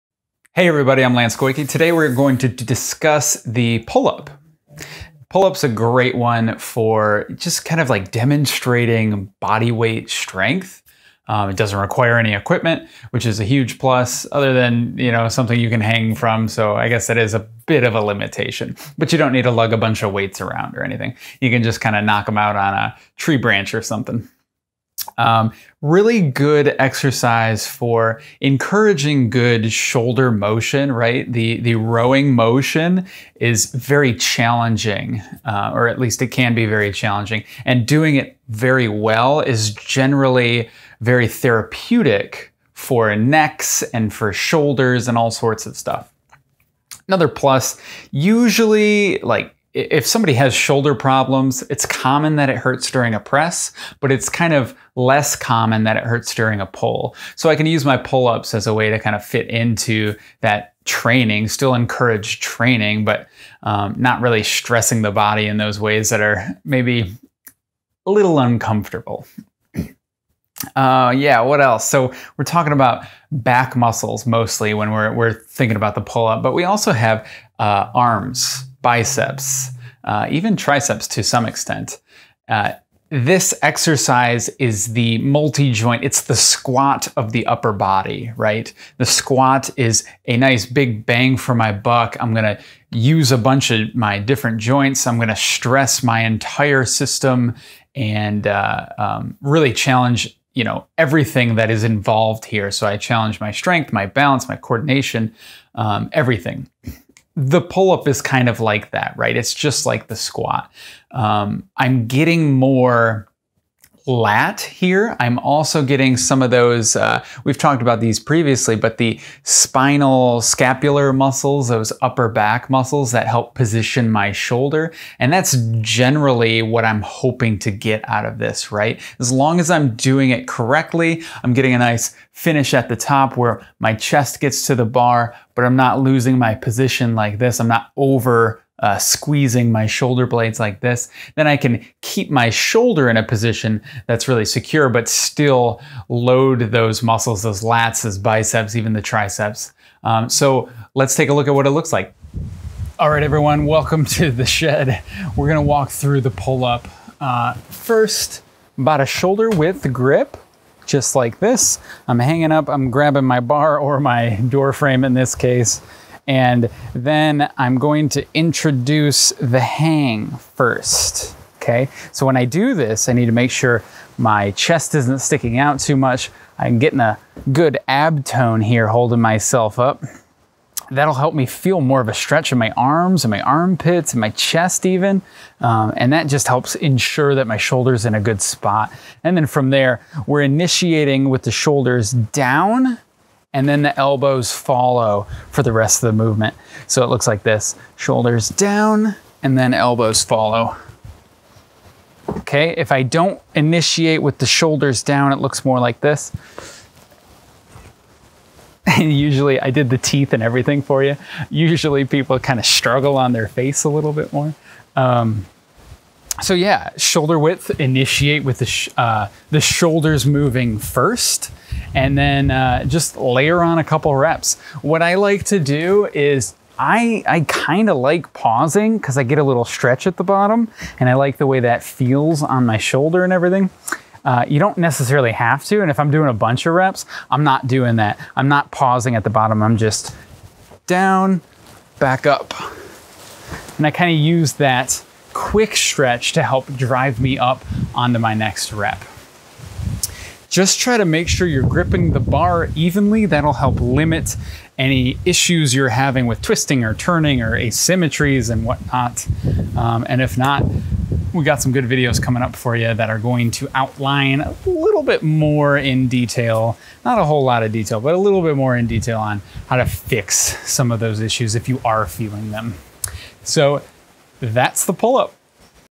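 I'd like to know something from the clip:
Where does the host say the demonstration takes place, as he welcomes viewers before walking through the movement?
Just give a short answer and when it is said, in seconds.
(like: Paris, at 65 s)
the shed, at 154 s.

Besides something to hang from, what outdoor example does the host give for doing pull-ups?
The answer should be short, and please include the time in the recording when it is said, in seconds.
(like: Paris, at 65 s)
a tree branch, at 22 s.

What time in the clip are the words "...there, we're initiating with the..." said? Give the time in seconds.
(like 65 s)
189 s.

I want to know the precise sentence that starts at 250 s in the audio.
Just try to make sure you're gripping the bar evenly.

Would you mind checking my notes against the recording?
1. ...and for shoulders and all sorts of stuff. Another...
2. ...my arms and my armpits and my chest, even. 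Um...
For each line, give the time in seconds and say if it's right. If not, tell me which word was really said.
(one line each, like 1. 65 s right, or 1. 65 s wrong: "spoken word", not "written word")
1. 43 s right
2. 182 s right.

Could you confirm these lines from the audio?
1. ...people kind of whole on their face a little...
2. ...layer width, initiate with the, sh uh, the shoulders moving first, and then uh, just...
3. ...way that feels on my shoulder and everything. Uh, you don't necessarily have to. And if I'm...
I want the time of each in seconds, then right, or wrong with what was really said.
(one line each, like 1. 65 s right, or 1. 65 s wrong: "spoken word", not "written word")
1. 212 s wrong: "struggle", not "whole"
2. 216 s wrong: "shoulder", not "layer"
3. 231 s right.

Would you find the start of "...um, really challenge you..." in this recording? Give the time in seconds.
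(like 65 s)
98 s.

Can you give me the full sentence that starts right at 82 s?
Uh, this exercise is the multi joint, it's the squat of the upper body, right?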